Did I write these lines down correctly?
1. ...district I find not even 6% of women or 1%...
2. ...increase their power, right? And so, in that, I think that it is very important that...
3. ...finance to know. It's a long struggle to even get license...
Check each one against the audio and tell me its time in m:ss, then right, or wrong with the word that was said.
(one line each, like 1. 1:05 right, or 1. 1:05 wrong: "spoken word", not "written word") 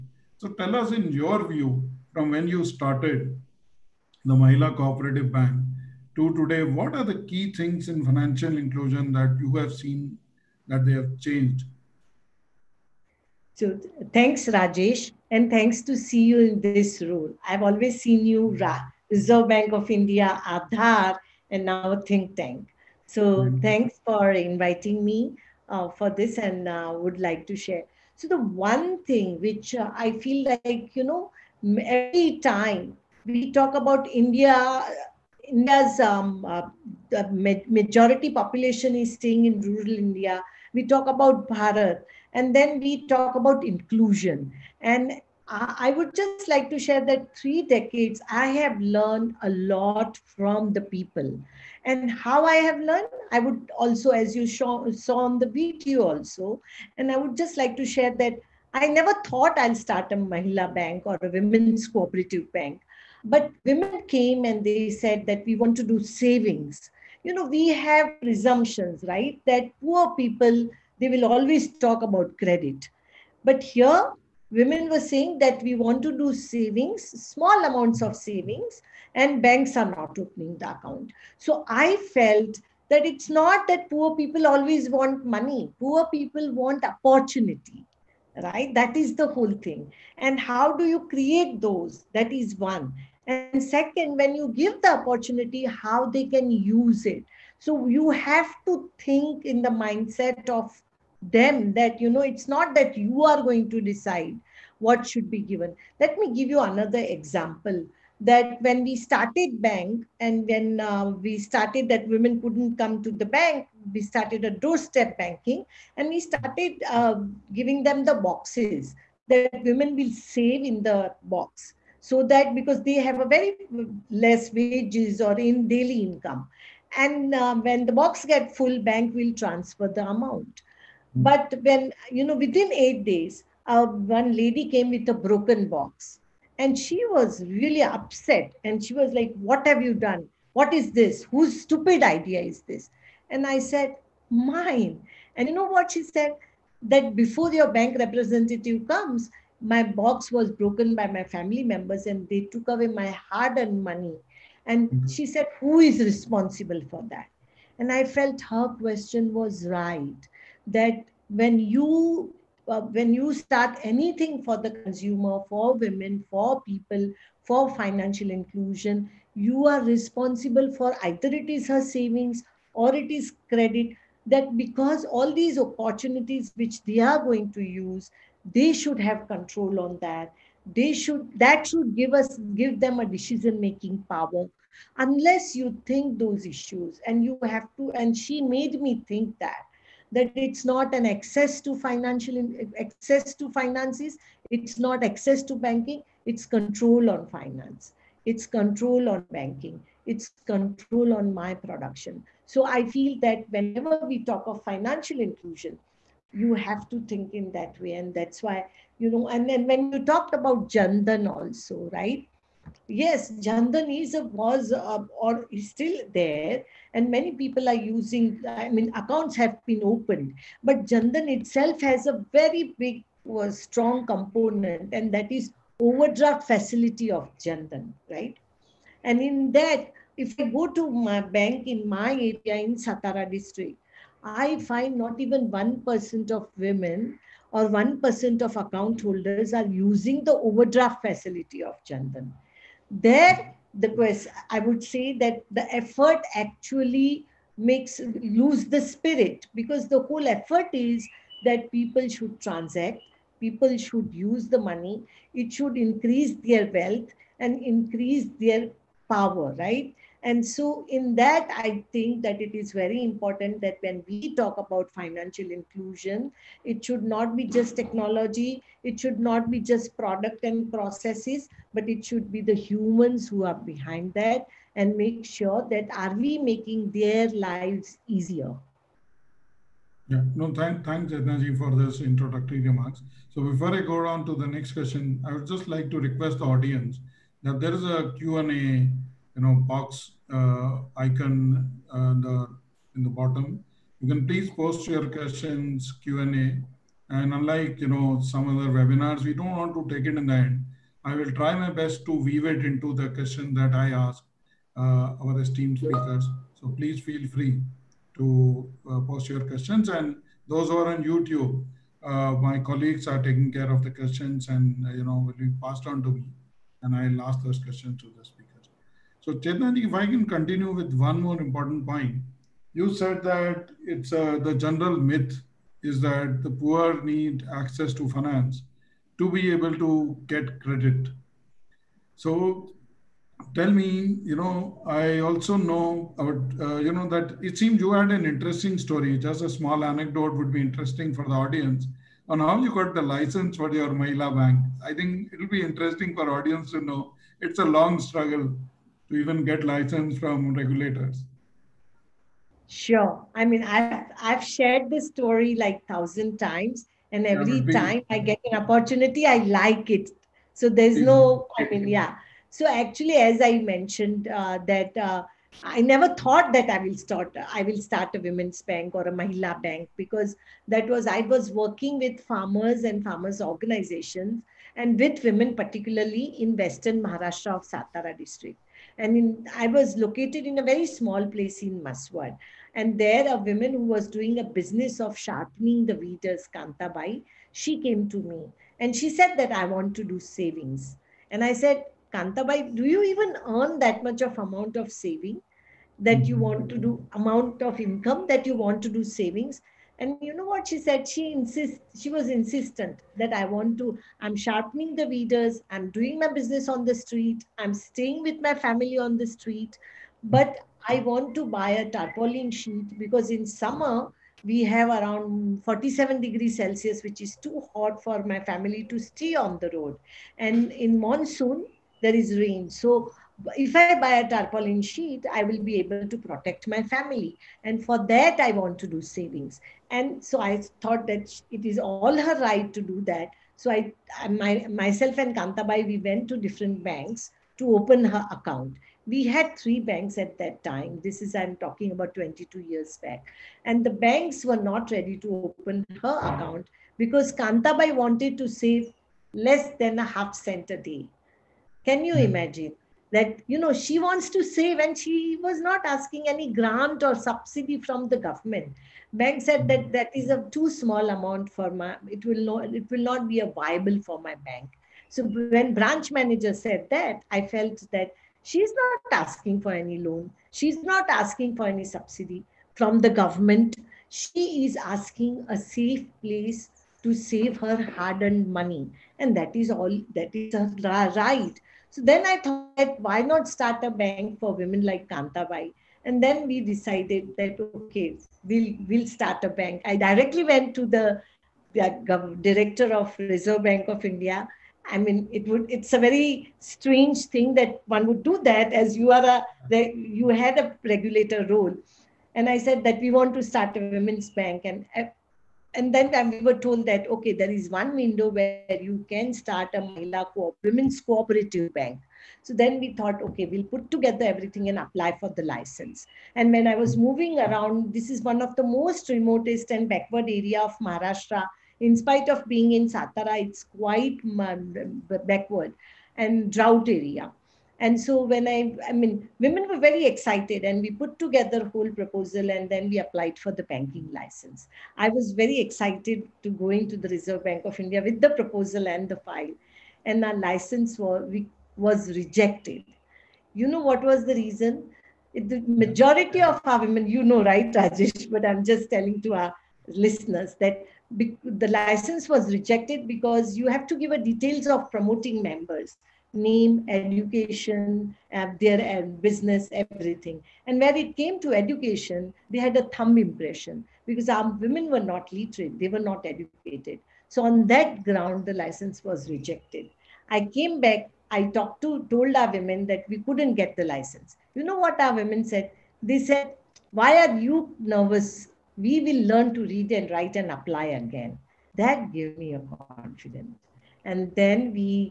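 1. 3:53 wrong: "1", not "6"
2. 4:17 right
3. 5:46 wrong: "audience", not "finance".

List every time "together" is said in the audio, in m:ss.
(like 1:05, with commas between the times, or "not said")
8:33, 8:51.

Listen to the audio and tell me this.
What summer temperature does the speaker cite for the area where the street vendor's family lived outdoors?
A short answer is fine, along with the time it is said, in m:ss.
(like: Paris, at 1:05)
47 degrees Celsius, at 6:55.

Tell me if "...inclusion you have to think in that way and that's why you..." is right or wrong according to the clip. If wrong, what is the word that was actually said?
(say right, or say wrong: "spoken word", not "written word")
right.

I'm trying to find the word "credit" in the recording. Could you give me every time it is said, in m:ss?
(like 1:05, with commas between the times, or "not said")
1:12, 2:53, 5:30.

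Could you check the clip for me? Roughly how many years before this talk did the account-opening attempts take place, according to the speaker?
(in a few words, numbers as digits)
22 years.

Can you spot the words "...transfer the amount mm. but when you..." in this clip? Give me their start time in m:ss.
2:09.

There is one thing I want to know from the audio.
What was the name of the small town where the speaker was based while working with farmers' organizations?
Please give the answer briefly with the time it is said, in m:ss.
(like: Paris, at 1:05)
Mhaswad, at 6:21.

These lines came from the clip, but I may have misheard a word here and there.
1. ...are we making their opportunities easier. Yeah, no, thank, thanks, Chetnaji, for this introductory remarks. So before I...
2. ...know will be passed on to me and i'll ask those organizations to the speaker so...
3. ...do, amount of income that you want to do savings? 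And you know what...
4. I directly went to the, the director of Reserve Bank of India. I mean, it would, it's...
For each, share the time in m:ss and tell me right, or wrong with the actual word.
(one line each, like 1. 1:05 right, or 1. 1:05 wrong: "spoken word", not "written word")
1. 4:35 wrong: "lives", not "opportunities"
2. 5:15 wrong: "questions", not "organizations"
3. 6:36 right
4. 8:09 right.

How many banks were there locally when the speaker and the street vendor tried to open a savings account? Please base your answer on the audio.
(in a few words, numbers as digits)
3.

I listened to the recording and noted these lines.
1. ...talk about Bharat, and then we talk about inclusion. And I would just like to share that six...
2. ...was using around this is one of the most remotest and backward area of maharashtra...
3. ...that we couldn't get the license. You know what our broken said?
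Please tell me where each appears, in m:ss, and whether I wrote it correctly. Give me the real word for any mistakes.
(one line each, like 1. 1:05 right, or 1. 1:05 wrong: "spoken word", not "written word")
1. 0:40 wrong: "three", not "six"
2. 8:36 wrong: "moving", not "using"
3. 9:32 wrong: "women", not "broken".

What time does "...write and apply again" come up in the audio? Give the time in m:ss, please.
9:40.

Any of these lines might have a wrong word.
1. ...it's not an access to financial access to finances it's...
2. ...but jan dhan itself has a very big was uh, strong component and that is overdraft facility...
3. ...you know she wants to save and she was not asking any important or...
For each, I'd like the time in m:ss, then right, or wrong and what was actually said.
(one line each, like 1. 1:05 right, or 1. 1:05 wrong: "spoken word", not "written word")
1. 3:10 right
2. 3:40 right
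3. 7:33 wrong: "grant", not "important".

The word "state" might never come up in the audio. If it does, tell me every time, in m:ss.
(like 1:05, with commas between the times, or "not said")
not said.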